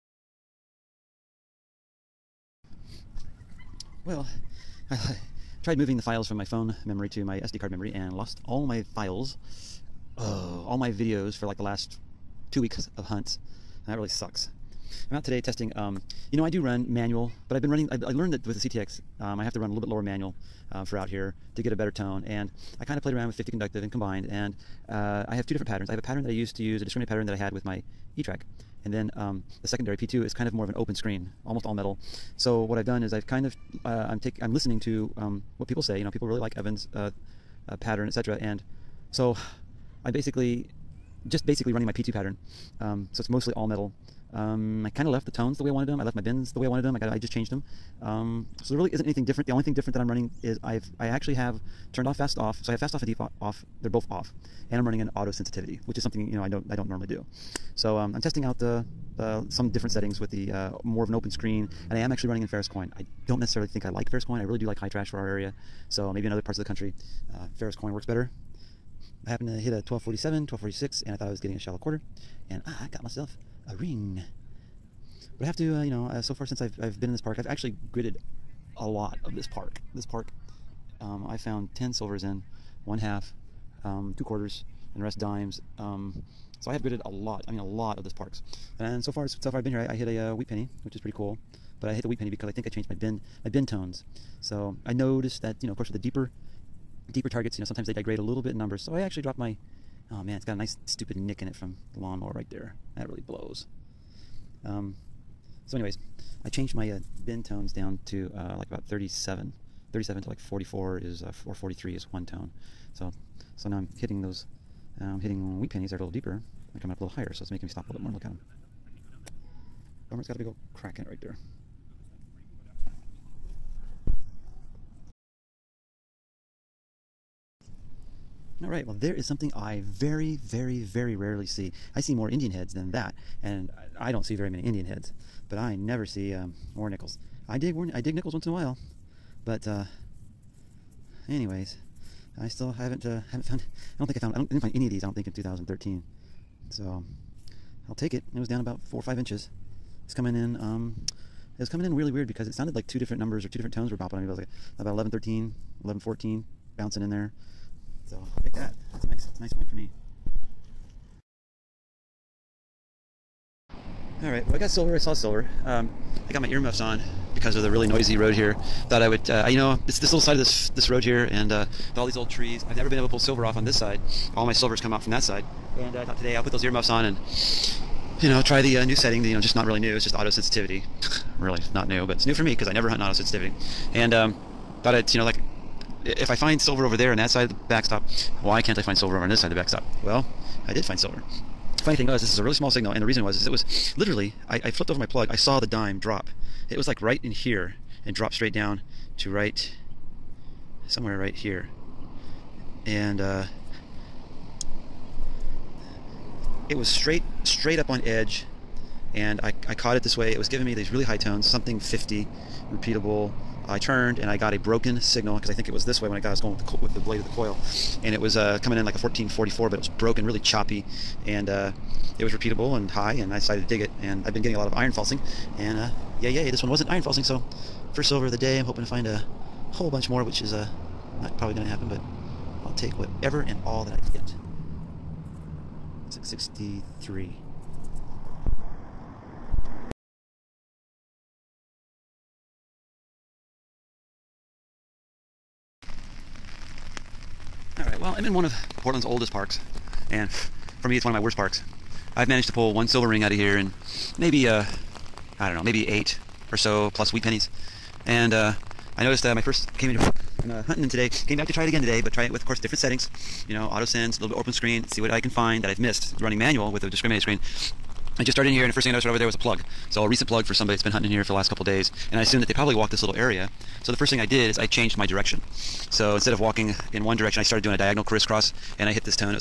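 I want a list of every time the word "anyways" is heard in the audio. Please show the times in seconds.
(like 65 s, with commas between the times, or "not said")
105 s, 141 s.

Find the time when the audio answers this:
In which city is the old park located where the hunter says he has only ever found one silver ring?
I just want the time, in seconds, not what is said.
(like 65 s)
248 s.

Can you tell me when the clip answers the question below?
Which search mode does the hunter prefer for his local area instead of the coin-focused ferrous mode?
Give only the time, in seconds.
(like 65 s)
64 s.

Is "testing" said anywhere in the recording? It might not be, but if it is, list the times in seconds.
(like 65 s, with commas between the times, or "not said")
15 s, 58 s.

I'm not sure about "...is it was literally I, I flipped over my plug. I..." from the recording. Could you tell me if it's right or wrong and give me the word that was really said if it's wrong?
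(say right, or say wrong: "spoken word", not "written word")
right.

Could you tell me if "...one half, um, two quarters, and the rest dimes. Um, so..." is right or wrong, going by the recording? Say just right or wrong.
right.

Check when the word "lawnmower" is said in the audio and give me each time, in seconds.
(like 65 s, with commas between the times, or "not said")
101 s.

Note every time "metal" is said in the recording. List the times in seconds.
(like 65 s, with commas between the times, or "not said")
31 s, 43 s.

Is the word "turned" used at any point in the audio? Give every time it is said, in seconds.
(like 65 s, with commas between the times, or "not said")
51 s, 213 s.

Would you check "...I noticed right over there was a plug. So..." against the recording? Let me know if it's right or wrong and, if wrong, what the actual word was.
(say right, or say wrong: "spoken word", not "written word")
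right.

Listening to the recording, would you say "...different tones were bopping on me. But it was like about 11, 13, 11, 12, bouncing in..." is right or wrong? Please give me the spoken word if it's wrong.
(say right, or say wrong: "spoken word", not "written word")
wrong: "14", not "12".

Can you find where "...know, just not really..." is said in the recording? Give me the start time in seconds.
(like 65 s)
179 s.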